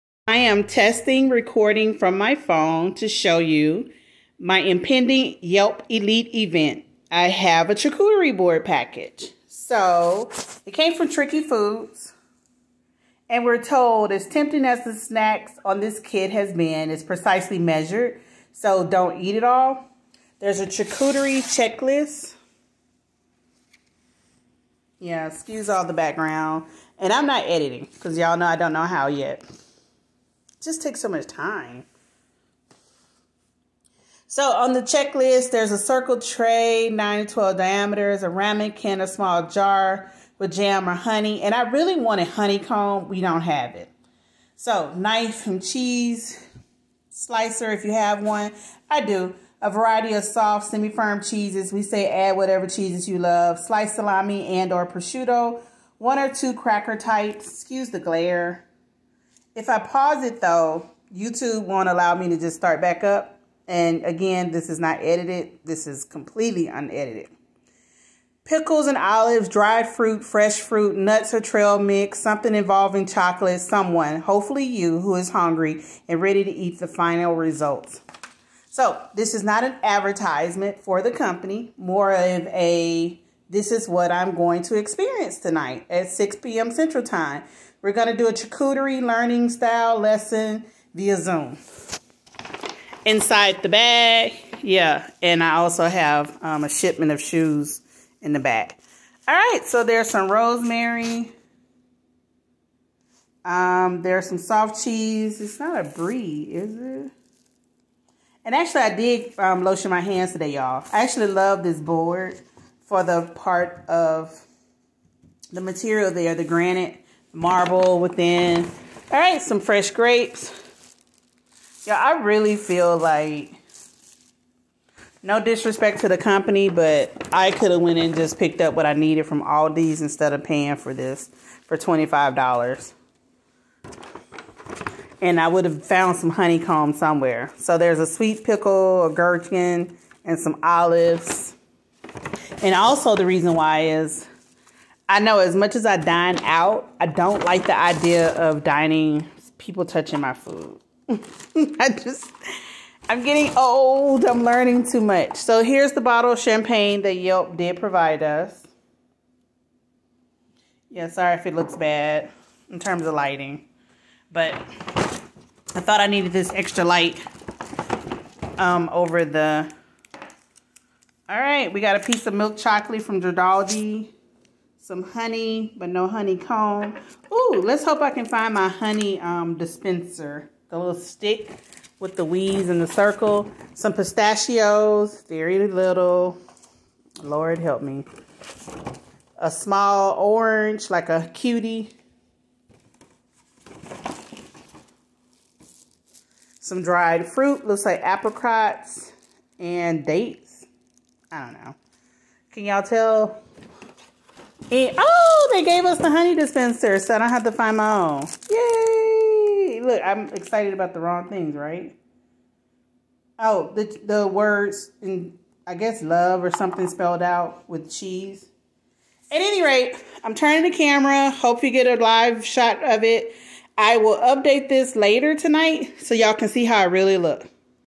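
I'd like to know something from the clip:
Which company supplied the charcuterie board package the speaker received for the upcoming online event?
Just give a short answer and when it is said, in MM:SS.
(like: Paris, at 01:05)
Tricky Foods, at 00:11.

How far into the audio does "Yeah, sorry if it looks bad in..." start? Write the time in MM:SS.
02:40.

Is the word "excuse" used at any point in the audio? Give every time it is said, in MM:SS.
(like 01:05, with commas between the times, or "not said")
00:25, 00:57.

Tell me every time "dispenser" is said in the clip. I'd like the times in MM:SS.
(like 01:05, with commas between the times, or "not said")
02:59, 03:26.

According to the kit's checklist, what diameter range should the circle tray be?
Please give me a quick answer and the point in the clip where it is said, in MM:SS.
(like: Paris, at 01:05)
9 to 12, at 00:36.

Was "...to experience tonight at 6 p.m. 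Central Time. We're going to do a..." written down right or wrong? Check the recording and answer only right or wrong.
right.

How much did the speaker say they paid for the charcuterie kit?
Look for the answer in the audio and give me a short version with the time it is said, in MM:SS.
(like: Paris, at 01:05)
$25, at 02:11.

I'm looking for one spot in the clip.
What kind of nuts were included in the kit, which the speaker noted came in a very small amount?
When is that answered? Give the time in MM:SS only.
03:03.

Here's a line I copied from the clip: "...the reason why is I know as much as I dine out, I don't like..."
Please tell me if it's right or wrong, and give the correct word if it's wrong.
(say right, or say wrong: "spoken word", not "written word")
right.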